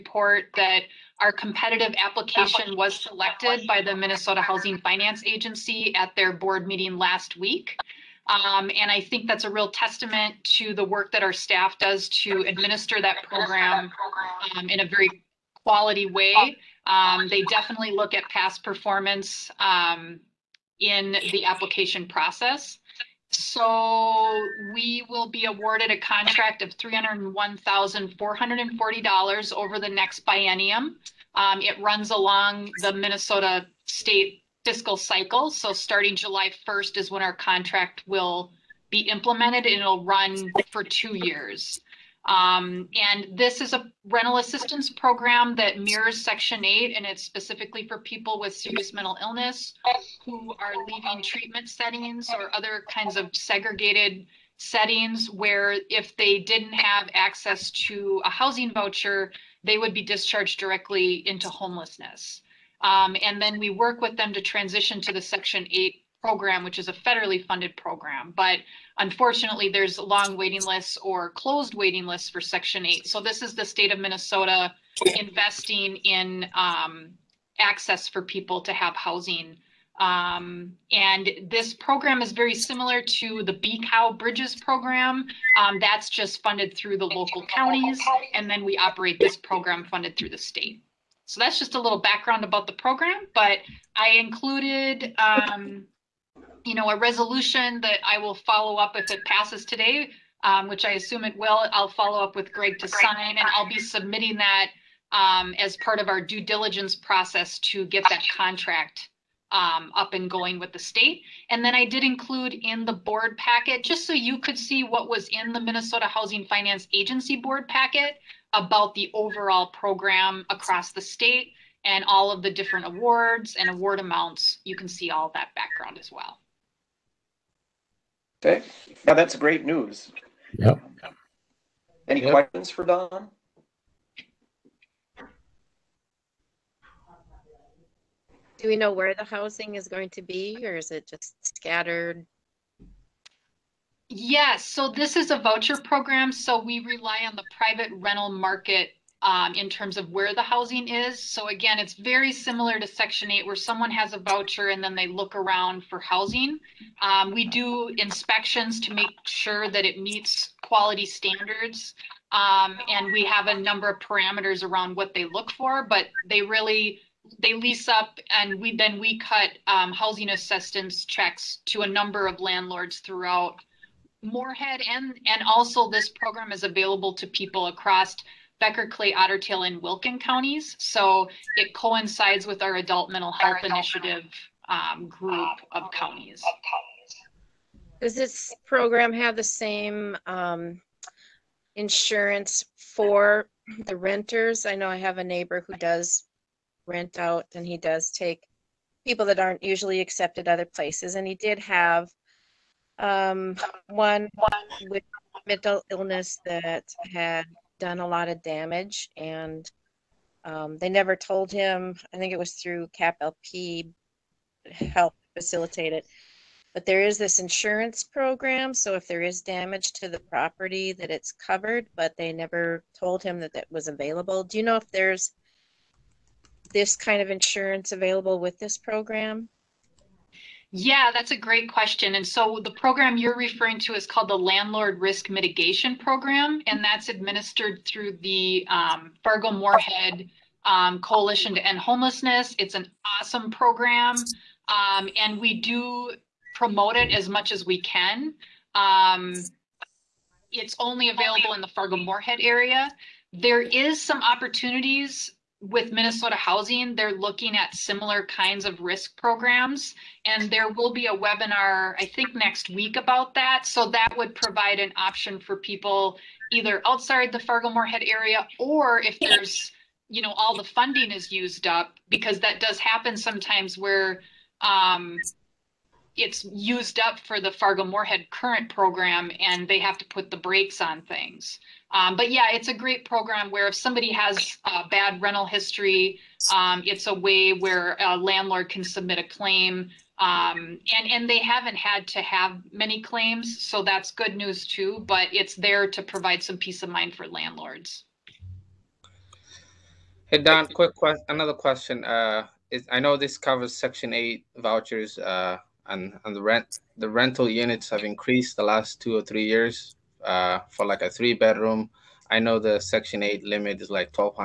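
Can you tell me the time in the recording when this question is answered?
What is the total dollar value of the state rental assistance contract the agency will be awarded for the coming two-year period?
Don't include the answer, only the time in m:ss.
0:26.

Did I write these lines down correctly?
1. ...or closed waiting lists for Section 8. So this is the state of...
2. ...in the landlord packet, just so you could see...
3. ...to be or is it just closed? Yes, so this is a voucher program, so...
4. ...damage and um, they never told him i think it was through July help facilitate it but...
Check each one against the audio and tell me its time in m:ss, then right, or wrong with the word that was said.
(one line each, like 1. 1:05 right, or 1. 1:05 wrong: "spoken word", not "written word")
1. 1:11 right
2. 1:52 wrong: "board", not "landlord"
3. 2:20 wrong: "scattered", not "closed"
4. 3:28 wrong: "CAPLP", not "July".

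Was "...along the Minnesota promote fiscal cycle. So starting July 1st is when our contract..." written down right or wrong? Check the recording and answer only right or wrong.
wrong.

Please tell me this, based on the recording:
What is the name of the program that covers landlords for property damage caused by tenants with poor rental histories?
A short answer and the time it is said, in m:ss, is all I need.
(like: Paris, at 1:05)
Landlord Risk Mitigation Program, at 3:54.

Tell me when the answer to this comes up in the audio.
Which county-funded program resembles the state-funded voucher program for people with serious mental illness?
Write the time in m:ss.
1:23.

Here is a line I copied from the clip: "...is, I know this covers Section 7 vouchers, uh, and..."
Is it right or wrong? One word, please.
wrong.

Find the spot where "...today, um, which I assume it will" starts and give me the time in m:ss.
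1:39.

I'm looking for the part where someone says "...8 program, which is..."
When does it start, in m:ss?
1:05.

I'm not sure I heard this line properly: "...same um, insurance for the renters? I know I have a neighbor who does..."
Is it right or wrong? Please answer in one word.
right.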